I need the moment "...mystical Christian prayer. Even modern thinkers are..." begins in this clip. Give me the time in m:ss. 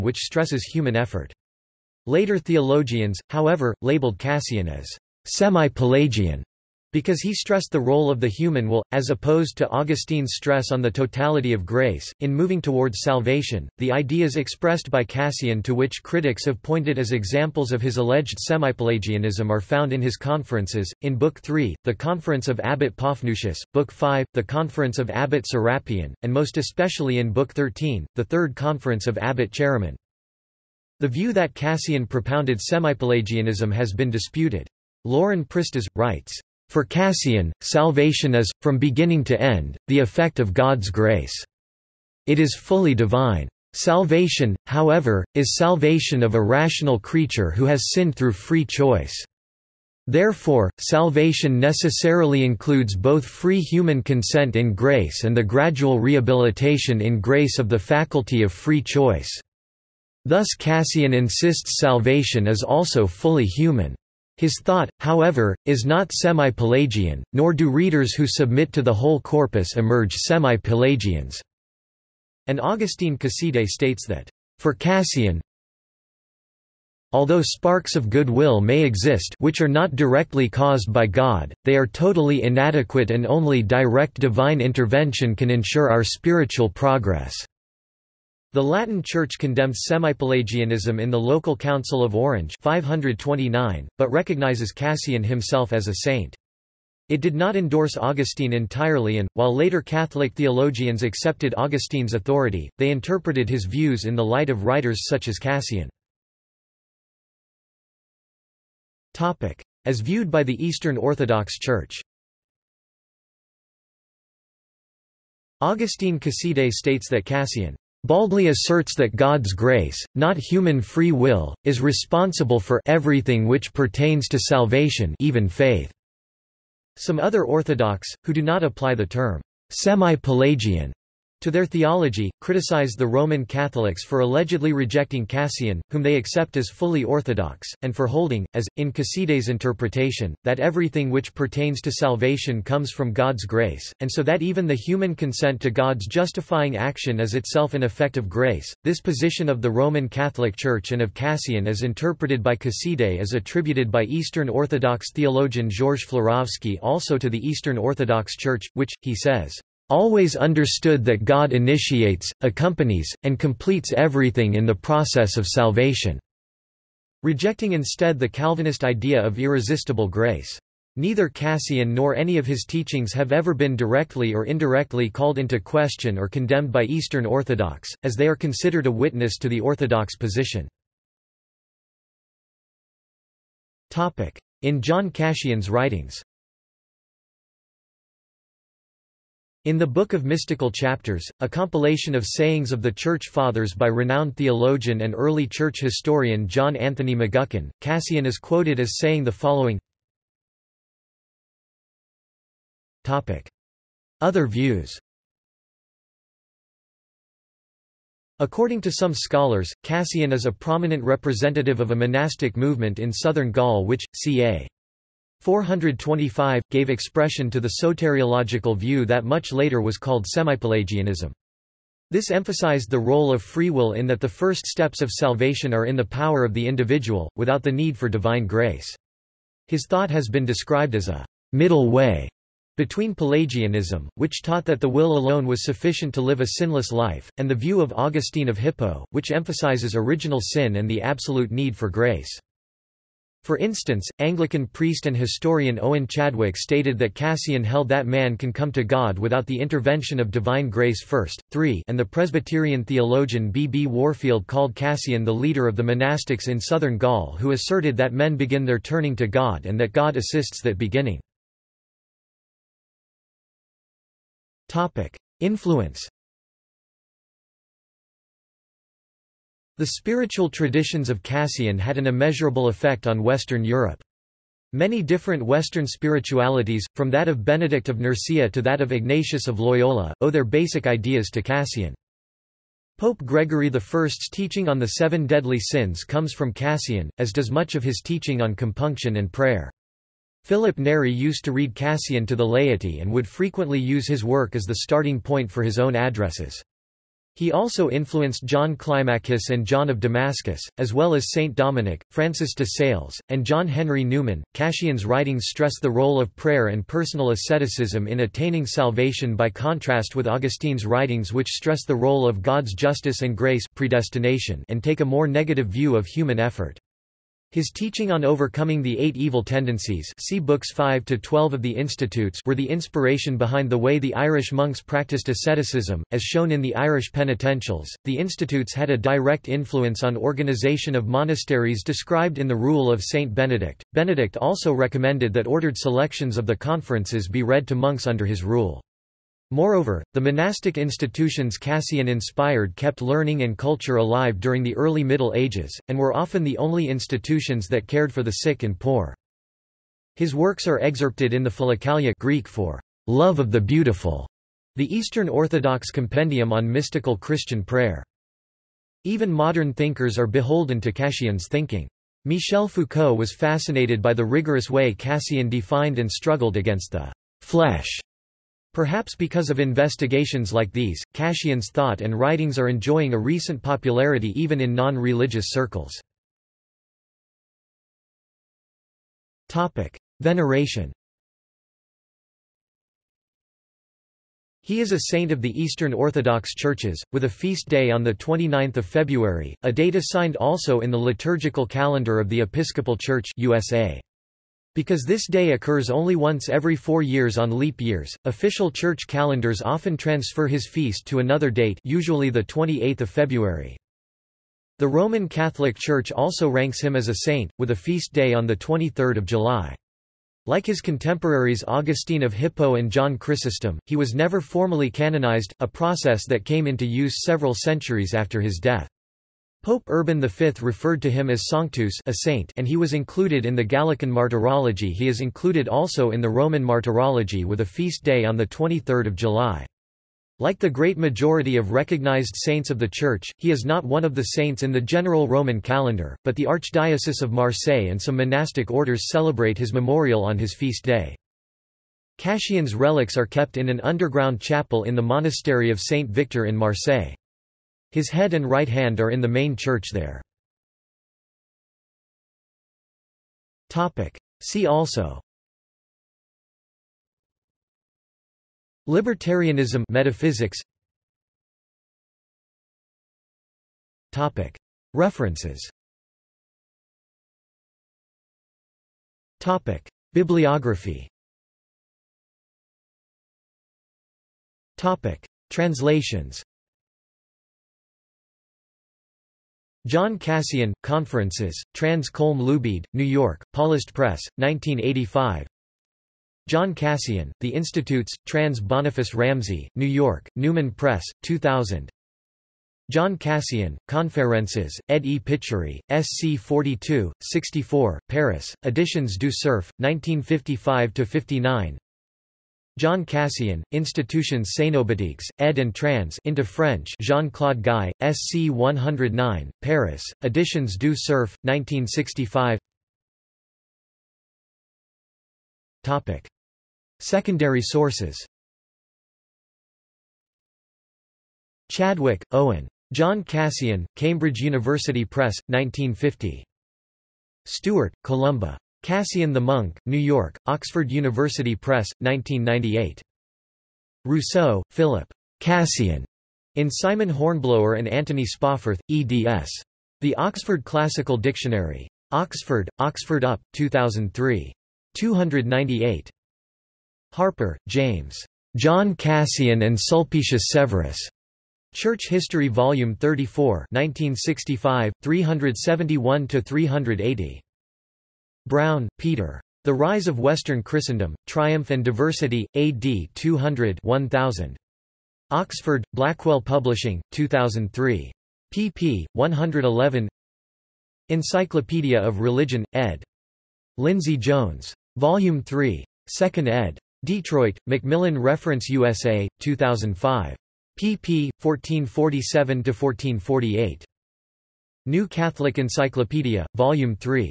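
5:56.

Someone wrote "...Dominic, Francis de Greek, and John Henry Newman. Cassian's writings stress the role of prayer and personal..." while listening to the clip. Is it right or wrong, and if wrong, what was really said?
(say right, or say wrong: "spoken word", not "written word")
wrong: "Sales", not "Greek".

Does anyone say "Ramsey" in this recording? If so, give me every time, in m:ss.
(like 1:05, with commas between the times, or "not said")
8:09.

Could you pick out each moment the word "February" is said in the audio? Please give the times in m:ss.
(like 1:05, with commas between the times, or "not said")
6:28, 6:43.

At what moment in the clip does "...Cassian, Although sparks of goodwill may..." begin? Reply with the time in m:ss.
1:14.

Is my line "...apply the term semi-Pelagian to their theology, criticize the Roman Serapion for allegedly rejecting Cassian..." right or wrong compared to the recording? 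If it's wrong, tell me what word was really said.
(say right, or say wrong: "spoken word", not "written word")
wrong: "Catholics", not "Serapion".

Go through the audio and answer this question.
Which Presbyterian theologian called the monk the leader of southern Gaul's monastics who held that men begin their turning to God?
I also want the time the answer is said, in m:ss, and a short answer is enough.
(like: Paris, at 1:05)
B. B. Warfield, at 4:13.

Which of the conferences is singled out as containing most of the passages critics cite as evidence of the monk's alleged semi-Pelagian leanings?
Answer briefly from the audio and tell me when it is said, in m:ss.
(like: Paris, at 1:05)
Third Conference of Abbot Chaeremon, at 0:28.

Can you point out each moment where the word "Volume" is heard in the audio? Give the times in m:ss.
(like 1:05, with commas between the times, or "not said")
9:12, 9:34, 9:46.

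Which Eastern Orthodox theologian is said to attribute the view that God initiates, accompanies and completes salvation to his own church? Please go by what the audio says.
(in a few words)
George Florovsky.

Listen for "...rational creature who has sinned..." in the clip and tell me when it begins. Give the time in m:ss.
0:46.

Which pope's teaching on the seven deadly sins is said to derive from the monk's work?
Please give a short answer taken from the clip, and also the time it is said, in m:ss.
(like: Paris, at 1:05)
Gregory I, at 4:42.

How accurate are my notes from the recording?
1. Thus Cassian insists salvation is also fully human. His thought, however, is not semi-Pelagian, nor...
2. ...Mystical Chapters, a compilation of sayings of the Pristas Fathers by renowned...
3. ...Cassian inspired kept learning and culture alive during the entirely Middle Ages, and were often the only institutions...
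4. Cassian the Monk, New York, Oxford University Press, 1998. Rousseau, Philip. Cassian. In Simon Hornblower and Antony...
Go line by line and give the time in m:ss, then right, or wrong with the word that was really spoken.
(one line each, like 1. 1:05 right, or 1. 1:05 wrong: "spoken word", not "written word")
1. 1:00 right
2. 3:10 wrong: "Church", not "Pristas"
3. 5:41 wrong: "early", not "entirely"
4. 8:48 right.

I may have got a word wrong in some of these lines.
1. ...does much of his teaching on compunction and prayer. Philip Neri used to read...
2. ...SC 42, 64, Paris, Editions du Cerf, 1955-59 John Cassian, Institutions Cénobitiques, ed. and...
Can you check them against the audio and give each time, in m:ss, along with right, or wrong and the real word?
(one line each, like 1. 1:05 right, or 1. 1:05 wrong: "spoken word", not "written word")
1. 4:47 right
2. 8:15 right.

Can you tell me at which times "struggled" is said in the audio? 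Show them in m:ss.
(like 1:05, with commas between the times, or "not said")
6:06.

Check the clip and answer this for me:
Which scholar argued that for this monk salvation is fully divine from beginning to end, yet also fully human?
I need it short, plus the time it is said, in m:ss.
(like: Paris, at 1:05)
Lauren Pristas, at 0:35.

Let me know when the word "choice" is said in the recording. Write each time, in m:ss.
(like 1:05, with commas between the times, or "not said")
0:48, 0:58.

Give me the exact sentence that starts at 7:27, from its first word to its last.
His head and right hand are in the main church there.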